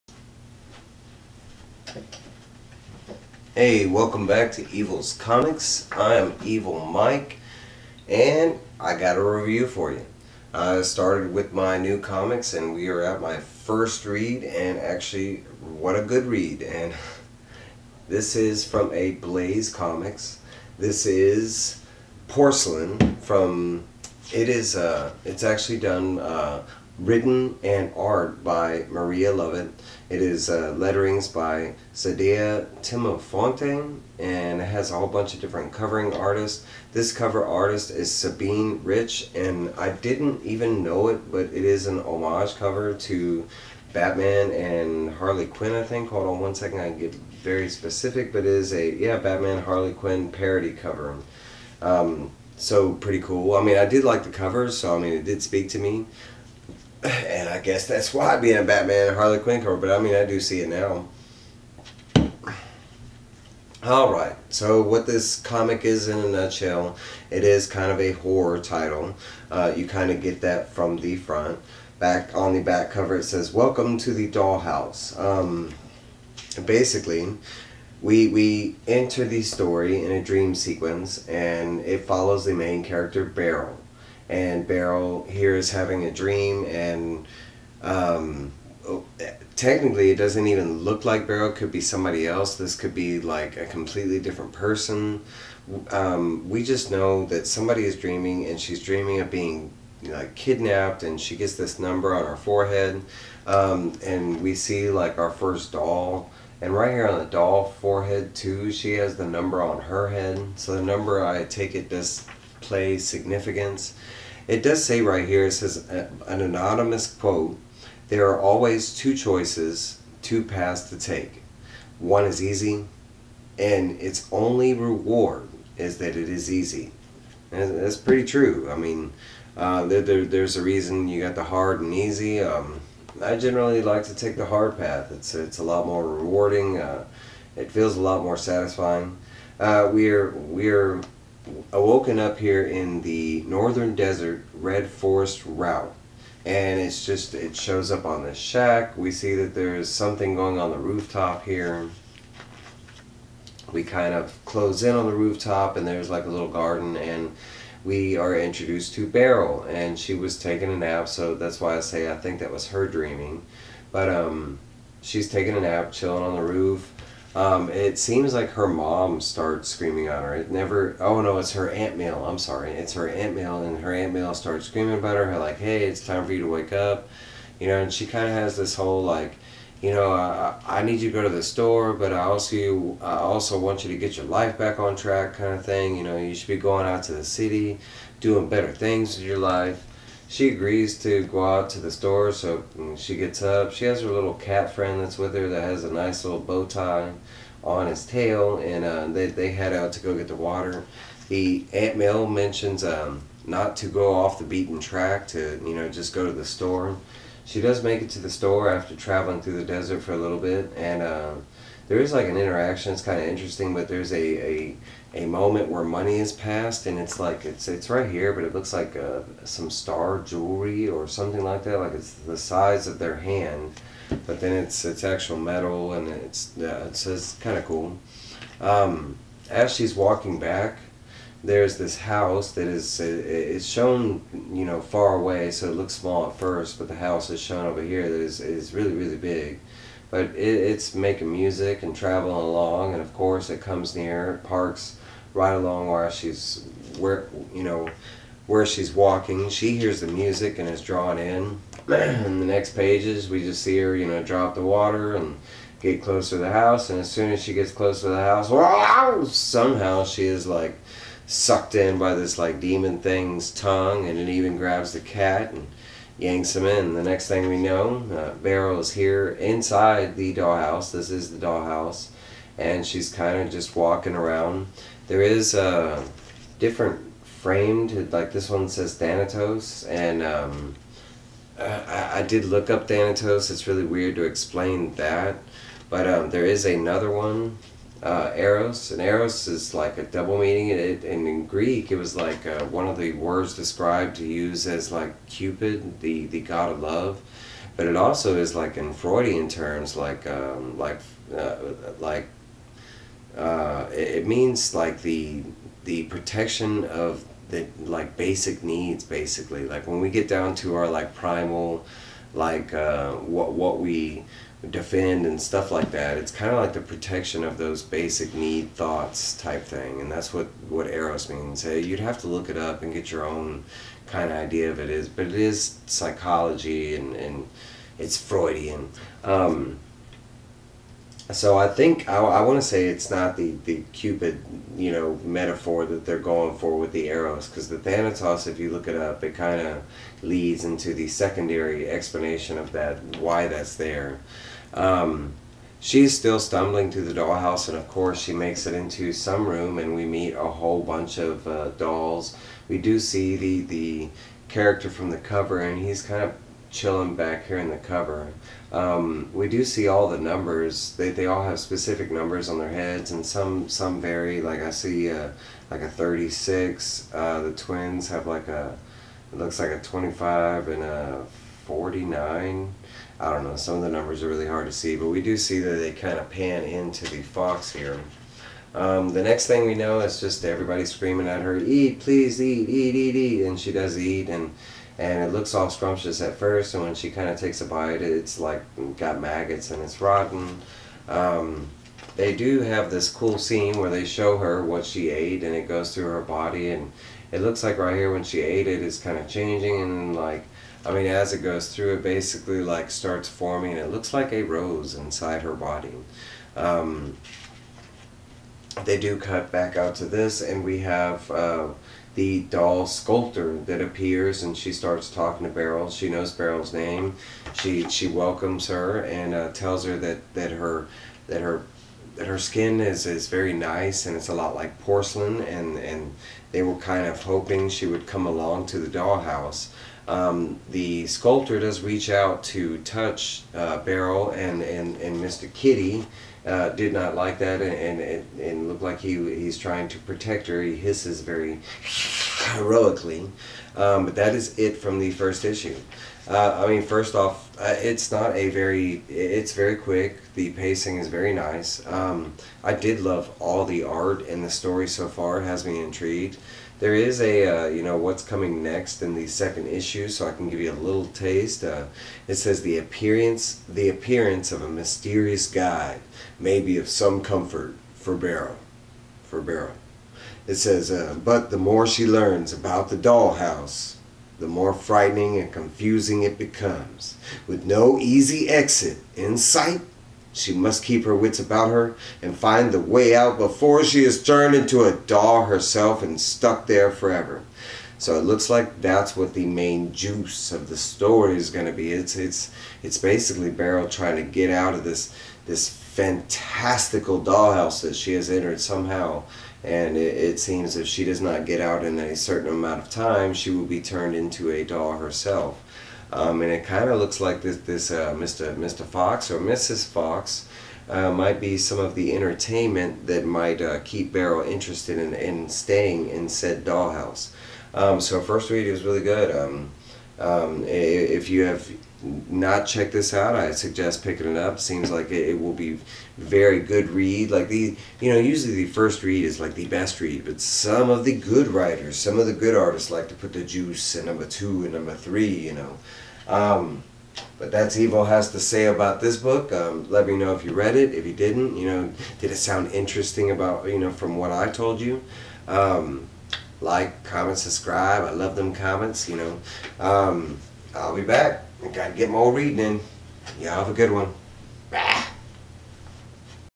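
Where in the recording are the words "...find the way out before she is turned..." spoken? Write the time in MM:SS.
08:02.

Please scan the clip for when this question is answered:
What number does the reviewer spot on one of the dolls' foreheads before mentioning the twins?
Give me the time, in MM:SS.
06:05.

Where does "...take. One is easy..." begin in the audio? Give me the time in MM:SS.
02:00.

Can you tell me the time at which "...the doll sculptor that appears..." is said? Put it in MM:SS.
06:52.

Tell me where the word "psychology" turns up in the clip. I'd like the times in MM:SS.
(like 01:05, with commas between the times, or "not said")
05:25.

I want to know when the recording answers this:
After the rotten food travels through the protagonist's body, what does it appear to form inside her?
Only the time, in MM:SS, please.
06:44.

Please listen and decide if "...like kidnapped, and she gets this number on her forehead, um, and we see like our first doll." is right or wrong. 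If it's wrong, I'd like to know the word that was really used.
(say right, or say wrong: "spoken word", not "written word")
right.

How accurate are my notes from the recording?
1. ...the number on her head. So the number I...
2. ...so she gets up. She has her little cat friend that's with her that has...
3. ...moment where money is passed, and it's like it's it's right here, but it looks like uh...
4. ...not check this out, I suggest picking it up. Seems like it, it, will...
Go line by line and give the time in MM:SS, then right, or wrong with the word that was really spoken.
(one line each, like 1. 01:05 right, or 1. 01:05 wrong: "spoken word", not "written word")
1. 01:49 right
2. 03:12 right
3. 03:35 right
4. 08:42 right.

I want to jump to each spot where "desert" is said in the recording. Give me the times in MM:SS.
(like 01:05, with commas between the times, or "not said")
02:23, 03:29.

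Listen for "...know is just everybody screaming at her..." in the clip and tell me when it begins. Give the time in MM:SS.
06:19.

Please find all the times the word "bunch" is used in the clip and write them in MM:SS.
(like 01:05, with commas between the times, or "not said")
00:35, 05:50.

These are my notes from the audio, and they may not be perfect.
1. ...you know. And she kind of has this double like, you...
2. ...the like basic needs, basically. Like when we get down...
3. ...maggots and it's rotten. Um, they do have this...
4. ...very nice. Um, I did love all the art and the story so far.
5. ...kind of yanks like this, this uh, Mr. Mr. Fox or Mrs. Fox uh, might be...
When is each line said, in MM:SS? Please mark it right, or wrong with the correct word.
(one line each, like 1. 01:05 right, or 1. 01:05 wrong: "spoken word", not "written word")
1. 02:57 wrong: "whole", not "double"
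2. 05:07 right
3. 06:29 right
4. 07:31 right
5. 08:26 wrong: "looks", not "yanks".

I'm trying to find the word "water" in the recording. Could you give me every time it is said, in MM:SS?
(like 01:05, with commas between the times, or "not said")
03:20, 04:14.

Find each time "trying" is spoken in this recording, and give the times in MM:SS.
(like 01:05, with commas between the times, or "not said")
07:19, 08:13.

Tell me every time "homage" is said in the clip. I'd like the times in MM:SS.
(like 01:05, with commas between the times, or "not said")
00:42.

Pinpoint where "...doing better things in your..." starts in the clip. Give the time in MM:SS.
03:08.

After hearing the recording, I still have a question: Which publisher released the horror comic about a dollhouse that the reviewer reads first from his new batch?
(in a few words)
Ablaze Comics.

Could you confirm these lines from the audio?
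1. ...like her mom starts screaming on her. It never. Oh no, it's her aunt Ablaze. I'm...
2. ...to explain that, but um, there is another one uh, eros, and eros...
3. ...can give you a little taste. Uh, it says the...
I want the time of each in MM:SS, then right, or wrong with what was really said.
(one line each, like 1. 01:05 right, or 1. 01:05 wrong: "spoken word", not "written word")
1. 02:48 wrong: "Mail", not "Ablaze"
2. 04:44 right
3. 07:40 right.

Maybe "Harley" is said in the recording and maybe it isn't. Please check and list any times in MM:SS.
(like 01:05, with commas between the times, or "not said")
00:45, 00:49, 00:59.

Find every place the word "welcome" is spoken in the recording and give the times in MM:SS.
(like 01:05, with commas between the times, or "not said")
00:03, 01:13, 06:58.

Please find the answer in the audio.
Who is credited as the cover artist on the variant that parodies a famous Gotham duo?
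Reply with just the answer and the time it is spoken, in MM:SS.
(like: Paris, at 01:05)
Sabine Rich, at 00:38.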